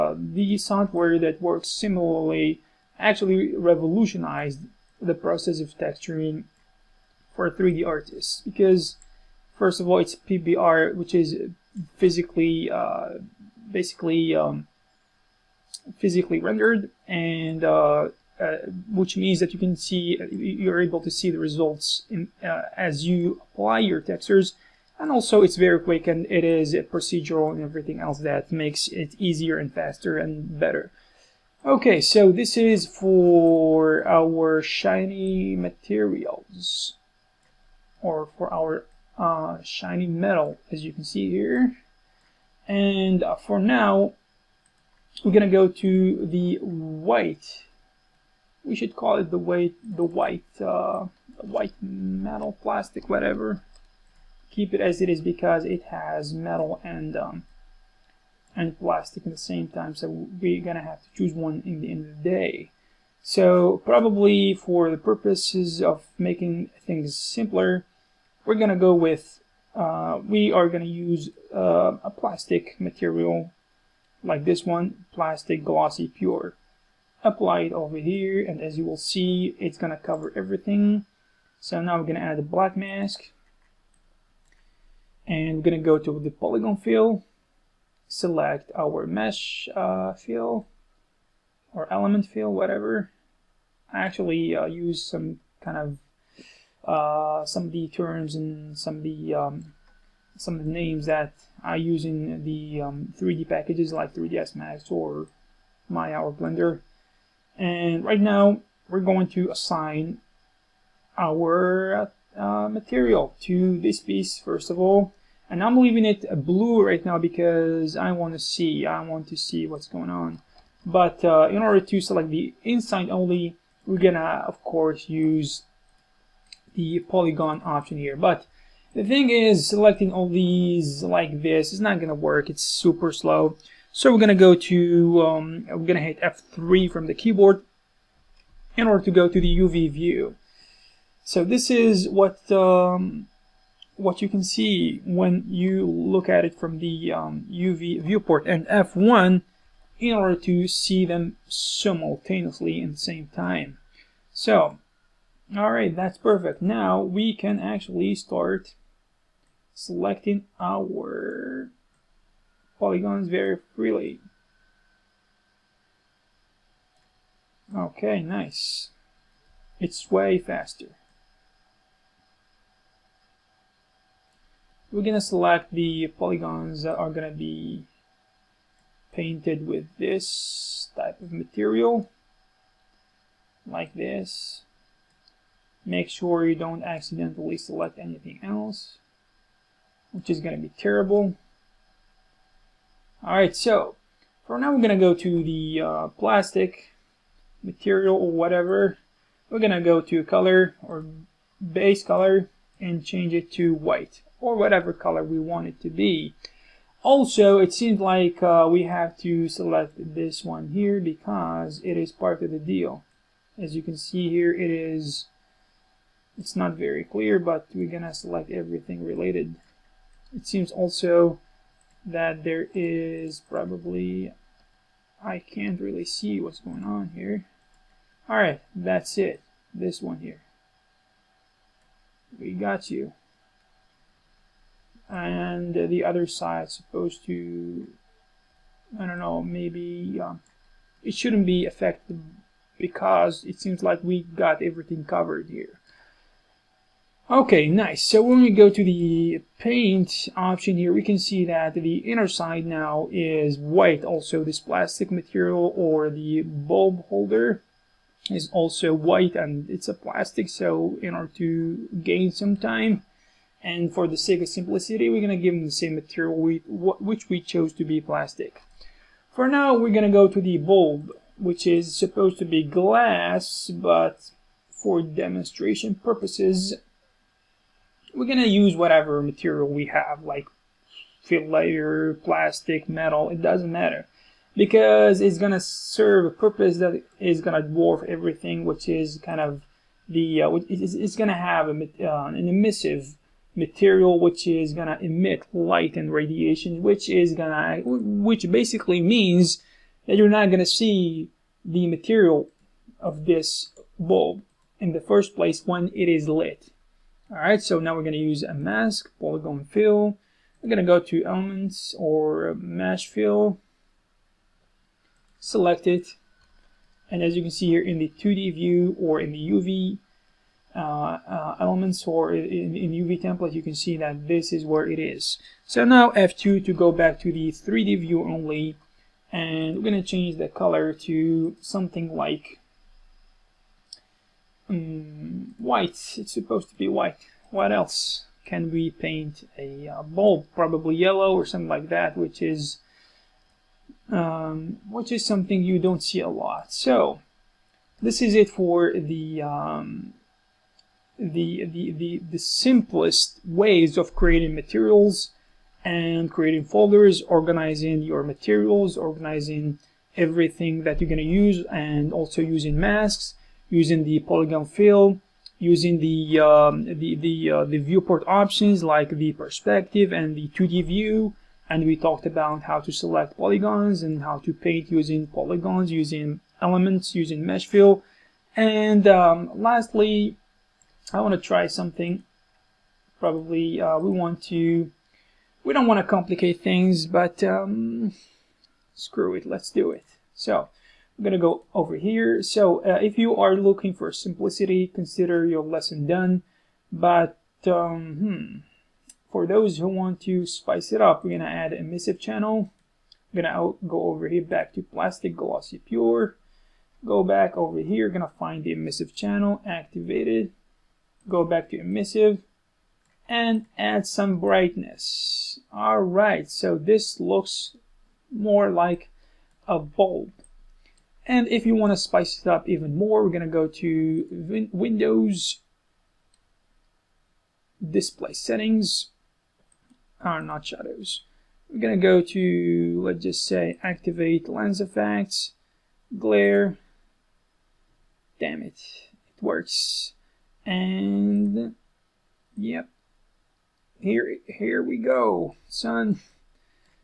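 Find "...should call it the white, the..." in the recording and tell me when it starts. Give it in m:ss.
0:48.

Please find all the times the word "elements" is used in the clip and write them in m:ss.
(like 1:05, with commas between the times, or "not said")
1:31, 5:11, 5:21, 6:16.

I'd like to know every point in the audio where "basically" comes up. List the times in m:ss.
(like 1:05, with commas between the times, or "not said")
0:13, 4:58.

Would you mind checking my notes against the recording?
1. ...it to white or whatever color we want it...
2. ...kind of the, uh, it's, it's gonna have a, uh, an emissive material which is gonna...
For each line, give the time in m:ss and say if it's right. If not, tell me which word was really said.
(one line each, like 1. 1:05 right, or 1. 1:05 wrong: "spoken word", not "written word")
1. 3:23 right
2. 4:49 right.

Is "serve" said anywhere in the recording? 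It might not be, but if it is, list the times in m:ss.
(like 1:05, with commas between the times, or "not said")
4:45.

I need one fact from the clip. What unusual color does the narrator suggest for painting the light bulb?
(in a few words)
yellow.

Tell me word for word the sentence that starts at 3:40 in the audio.
It seems also that there is probably, I can't really see what's going on here.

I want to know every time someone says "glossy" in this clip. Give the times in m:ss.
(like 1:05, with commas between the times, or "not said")
1:15, 6:45.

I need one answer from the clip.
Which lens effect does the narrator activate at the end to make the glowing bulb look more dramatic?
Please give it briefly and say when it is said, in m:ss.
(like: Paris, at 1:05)
Glare, at 7:16.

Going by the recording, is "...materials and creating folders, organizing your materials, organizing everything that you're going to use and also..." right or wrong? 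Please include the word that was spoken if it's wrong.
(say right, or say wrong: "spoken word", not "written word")
right.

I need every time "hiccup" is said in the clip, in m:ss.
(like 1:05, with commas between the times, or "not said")
not said.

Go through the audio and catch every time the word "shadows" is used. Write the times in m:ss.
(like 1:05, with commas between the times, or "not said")
7:10.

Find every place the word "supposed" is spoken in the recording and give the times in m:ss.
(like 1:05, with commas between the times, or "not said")
3:56, 4:31, 5:36.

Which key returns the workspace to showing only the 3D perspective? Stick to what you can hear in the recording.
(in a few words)
F2.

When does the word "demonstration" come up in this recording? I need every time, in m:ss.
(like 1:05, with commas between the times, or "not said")
4:35.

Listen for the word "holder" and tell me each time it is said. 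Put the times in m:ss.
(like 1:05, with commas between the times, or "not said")
4:17.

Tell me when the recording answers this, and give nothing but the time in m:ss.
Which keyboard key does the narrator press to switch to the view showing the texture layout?
2:16.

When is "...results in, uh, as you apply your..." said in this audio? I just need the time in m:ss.
0:21.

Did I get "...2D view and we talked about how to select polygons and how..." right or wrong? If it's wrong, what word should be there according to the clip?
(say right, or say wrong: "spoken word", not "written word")
right.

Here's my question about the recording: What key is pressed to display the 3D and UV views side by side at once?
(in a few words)
F1.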